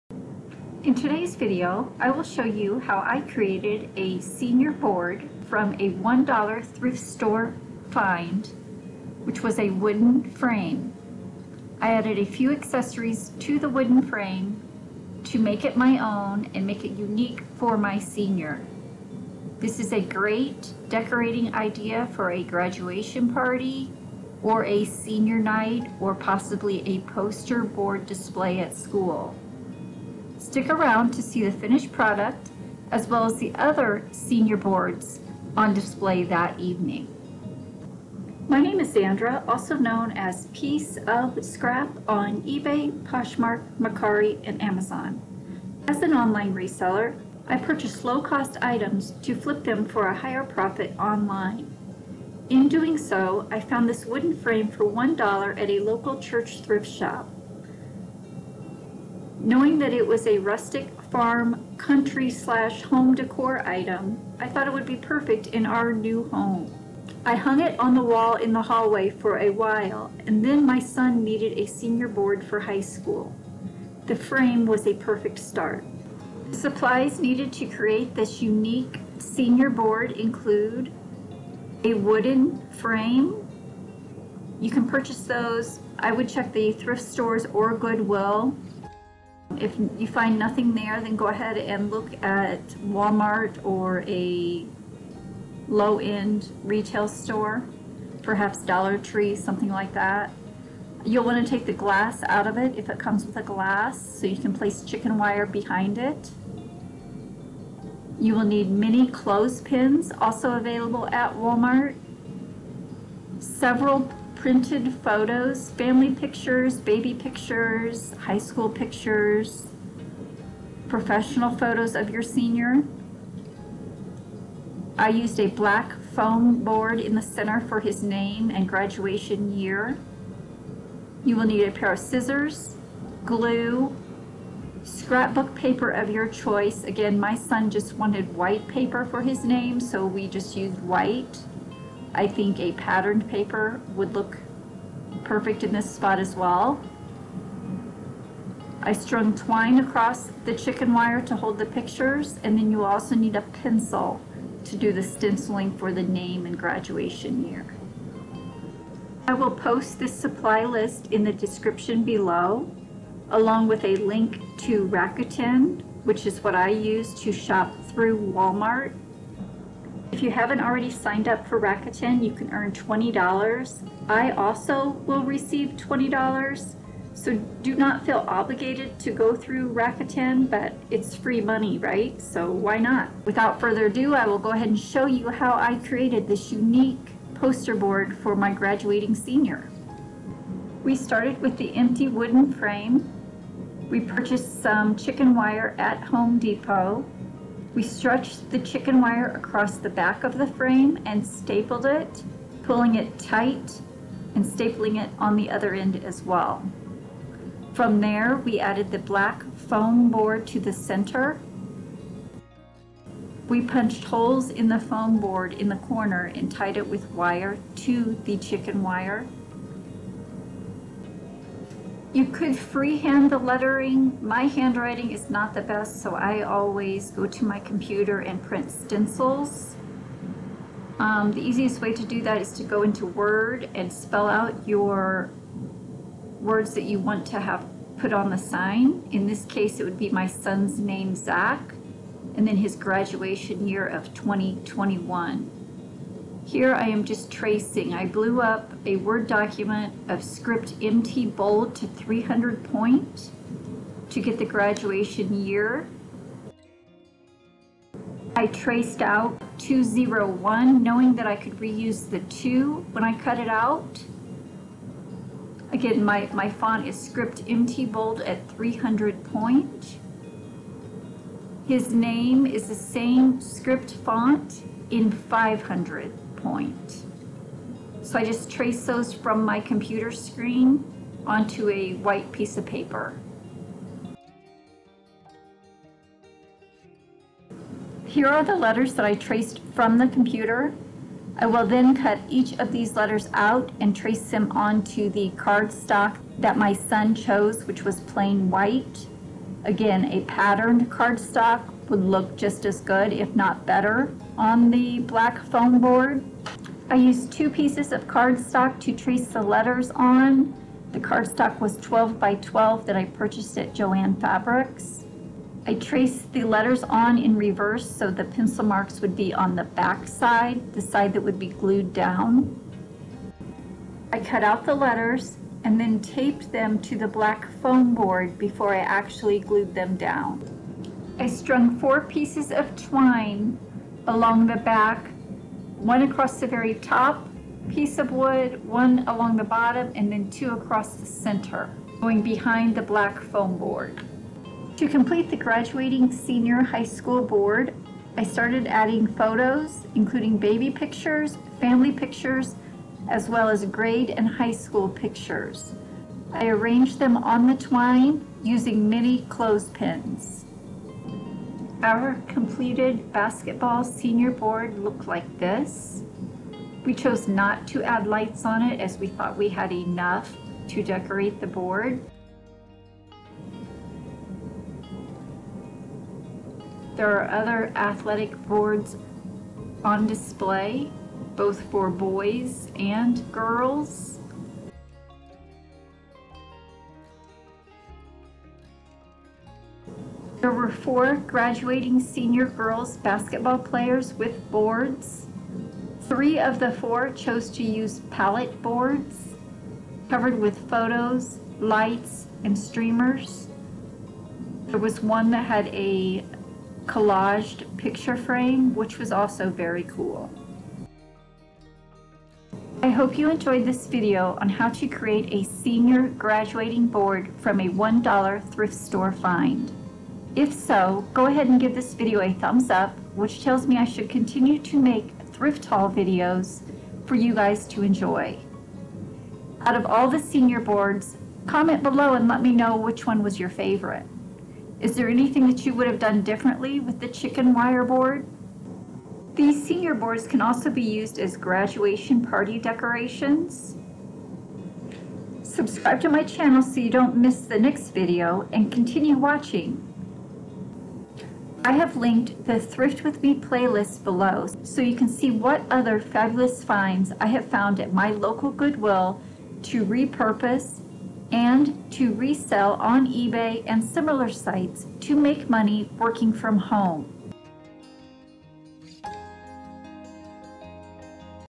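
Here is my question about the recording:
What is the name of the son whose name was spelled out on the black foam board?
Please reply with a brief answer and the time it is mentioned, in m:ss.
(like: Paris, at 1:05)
Zach, at 4:01.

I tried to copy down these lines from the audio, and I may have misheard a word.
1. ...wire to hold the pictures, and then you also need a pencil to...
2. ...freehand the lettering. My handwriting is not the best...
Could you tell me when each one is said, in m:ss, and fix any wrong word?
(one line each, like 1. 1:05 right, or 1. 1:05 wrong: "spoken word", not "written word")
1. 2:30 right
2. 3:42 right.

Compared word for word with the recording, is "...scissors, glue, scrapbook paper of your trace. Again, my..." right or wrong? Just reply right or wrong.
wrong.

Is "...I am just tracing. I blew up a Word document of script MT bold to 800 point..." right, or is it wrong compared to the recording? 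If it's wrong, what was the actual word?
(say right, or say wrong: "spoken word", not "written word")
wrong: "300", not "800".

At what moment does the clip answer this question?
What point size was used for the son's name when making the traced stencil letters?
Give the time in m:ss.
4:35.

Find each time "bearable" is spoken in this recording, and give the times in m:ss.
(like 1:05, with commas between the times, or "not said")
not said.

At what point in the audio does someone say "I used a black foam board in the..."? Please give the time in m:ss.
2:04.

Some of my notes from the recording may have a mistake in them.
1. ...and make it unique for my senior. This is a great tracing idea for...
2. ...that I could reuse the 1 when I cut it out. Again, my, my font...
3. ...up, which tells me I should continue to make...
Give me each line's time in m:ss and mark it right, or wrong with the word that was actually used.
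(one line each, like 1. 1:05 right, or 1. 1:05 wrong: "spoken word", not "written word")
1. 0:16 wrong: "decorating", not "tracing"
2. 4:21 wrong: "2", not "1"
3. 7:02 right.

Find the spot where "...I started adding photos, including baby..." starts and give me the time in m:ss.
5:48.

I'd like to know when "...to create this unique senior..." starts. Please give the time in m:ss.
1:17.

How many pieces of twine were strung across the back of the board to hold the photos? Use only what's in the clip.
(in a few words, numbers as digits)
4.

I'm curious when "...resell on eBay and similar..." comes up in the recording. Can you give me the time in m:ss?
7:42.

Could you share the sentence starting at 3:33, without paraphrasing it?
We punched holes in the foam board in the corner and tied it with wire to the chicken wire.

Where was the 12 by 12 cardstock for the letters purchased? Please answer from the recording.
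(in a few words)
Joann Fabrics.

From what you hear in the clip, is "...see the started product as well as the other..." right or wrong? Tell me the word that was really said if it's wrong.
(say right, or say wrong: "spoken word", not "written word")
wrong: "finished", not "started".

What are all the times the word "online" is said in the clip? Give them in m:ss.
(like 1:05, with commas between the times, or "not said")
0:46, 0:50.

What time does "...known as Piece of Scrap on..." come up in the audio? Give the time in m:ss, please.
0:39.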